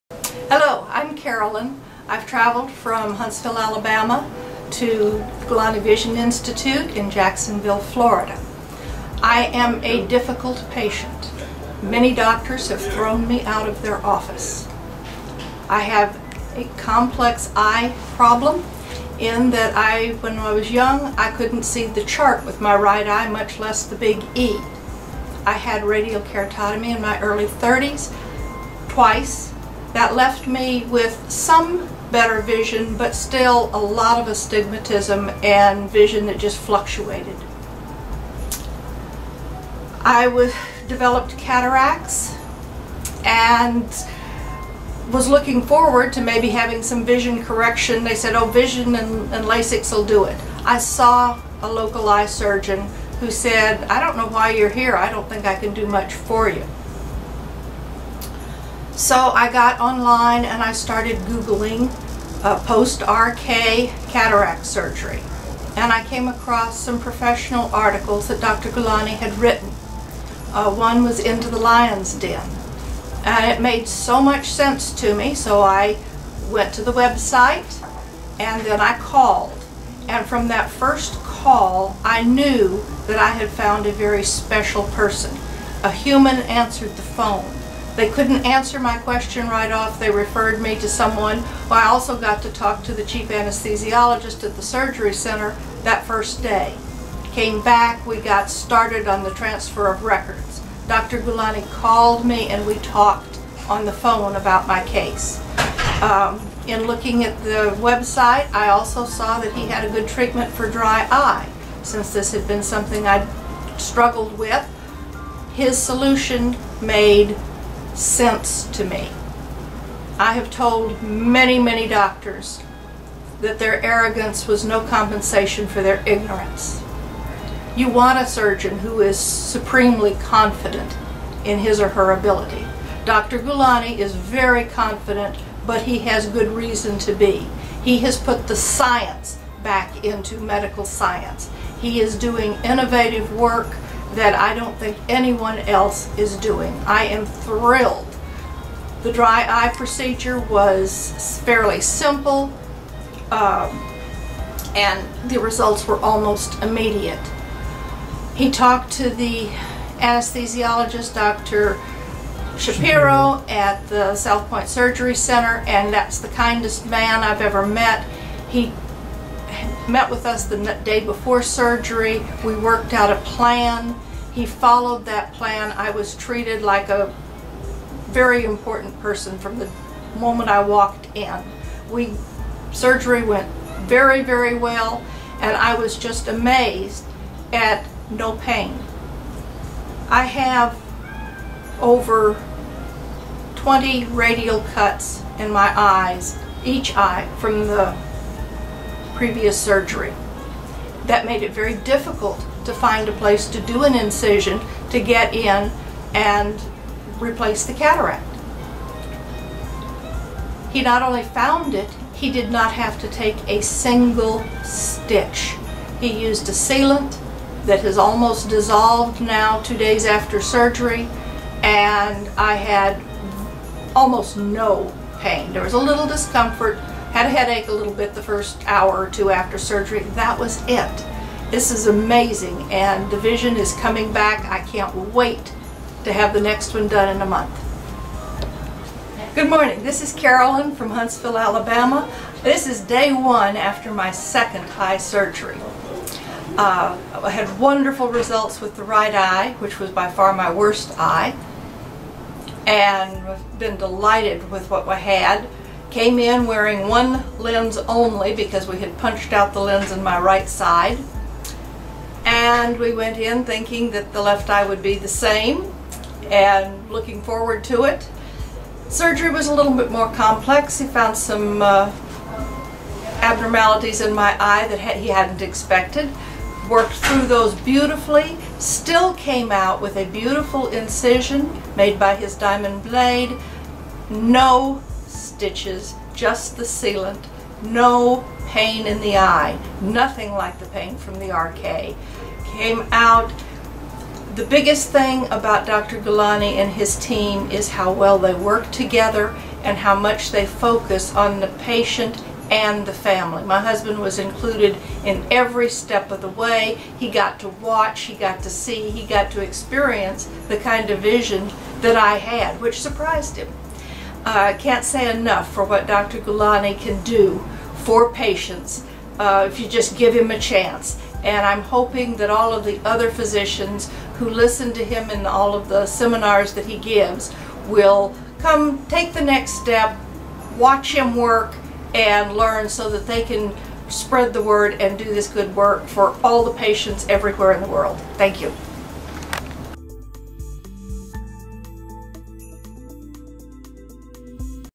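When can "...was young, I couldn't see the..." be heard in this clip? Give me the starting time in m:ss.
0:20.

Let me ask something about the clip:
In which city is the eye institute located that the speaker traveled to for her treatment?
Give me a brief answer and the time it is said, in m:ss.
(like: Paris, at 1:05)
Jacksonville, at 0:07.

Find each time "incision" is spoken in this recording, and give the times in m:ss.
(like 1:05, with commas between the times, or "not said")
3:23, 4:40.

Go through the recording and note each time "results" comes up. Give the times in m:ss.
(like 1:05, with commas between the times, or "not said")
2:35, 4:08.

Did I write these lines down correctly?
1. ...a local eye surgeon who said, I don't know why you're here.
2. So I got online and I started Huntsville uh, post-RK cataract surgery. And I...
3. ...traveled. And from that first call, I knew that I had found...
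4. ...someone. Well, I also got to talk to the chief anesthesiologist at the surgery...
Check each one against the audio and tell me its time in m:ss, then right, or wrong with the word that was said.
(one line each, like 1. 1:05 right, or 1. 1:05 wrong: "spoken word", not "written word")
1. 0:51 right
2. 0:59 wrong: "Googling", not "Huntsville"
3. 1:18 wrong: "called", not "traveled"
4. 1:30 right.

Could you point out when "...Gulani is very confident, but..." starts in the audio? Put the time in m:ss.
2:13.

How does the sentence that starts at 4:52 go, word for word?
Came out, the biggest thing about Dr.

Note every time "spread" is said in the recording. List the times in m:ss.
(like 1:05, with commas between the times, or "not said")
5:33.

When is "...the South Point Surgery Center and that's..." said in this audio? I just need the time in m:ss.
2:43.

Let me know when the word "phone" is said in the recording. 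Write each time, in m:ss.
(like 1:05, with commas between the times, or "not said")
1:27, 1:43.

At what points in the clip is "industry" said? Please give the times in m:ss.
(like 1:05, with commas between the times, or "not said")
not said.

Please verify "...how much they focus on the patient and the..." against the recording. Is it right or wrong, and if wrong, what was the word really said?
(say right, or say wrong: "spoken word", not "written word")
right.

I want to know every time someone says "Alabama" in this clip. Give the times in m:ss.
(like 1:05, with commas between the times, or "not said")
0:03, 4:01.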